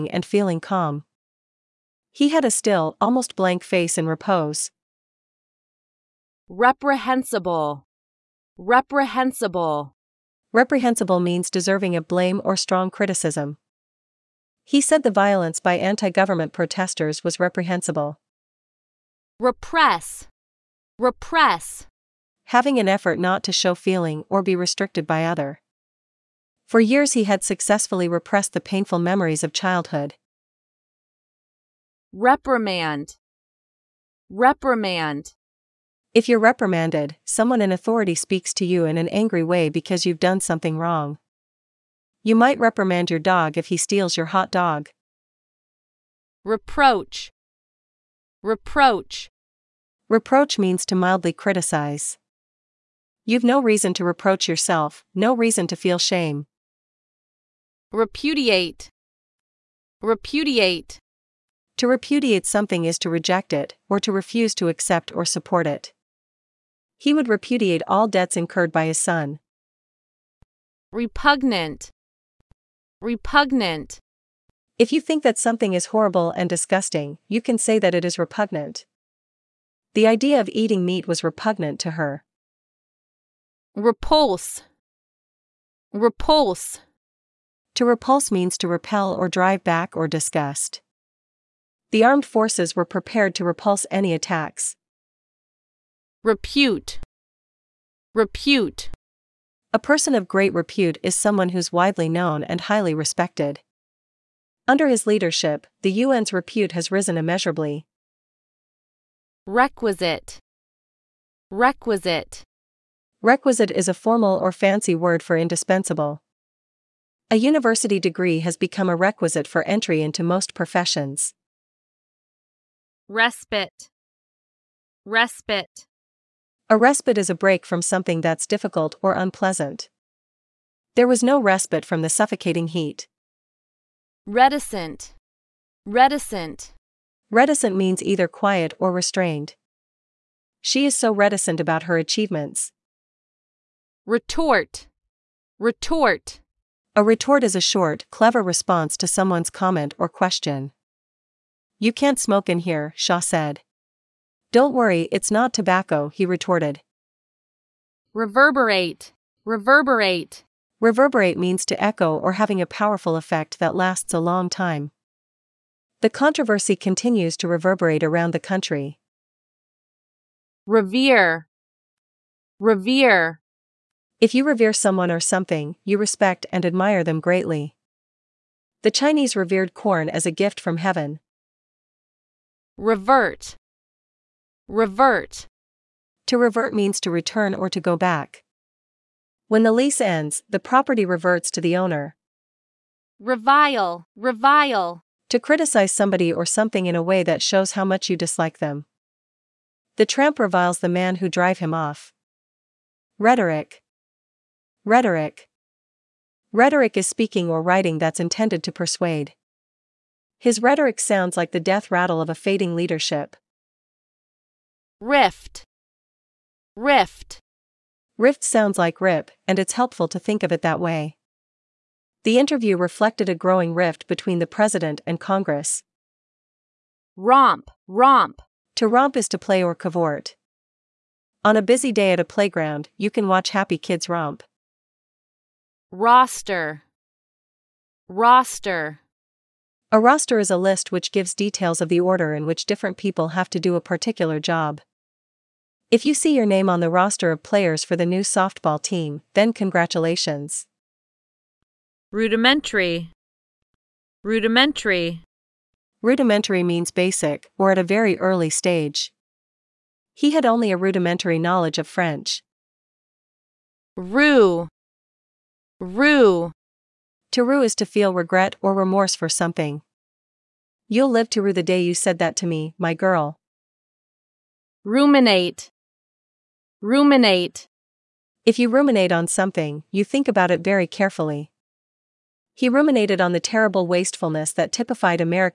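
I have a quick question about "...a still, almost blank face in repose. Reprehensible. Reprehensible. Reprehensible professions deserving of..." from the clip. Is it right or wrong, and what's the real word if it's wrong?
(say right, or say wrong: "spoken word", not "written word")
wrong: "means", not "professions".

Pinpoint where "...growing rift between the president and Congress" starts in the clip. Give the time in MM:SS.
03:43.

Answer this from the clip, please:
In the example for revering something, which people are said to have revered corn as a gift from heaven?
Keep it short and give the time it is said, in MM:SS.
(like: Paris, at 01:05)
The Chinese, at 02:58.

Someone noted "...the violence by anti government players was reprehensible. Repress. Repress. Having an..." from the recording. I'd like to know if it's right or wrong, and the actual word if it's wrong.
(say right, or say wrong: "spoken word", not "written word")
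wrong: "protesters", not "players".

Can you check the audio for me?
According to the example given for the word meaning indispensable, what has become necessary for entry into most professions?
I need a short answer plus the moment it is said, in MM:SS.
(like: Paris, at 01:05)
A university degree, at 01:57.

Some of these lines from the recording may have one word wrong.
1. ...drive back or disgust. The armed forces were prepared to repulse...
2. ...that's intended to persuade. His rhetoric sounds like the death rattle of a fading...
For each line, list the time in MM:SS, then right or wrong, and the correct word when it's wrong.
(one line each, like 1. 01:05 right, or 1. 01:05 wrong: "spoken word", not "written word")
1. 01:29 right
2. 03:27 right.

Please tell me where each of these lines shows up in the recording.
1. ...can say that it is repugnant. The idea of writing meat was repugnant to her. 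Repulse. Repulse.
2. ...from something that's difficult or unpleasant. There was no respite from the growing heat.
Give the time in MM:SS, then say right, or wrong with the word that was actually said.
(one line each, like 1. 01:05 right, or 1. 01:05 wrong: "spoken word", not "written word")
1. 01:17 wrong: "eating", not "writing"
2. 02:07 wrong: "suffocating", not "growing".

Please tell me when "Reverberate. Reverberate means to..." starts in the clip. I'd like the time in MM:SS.
02:39.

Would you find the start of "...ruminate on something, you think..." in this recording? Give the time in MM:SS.
04:38.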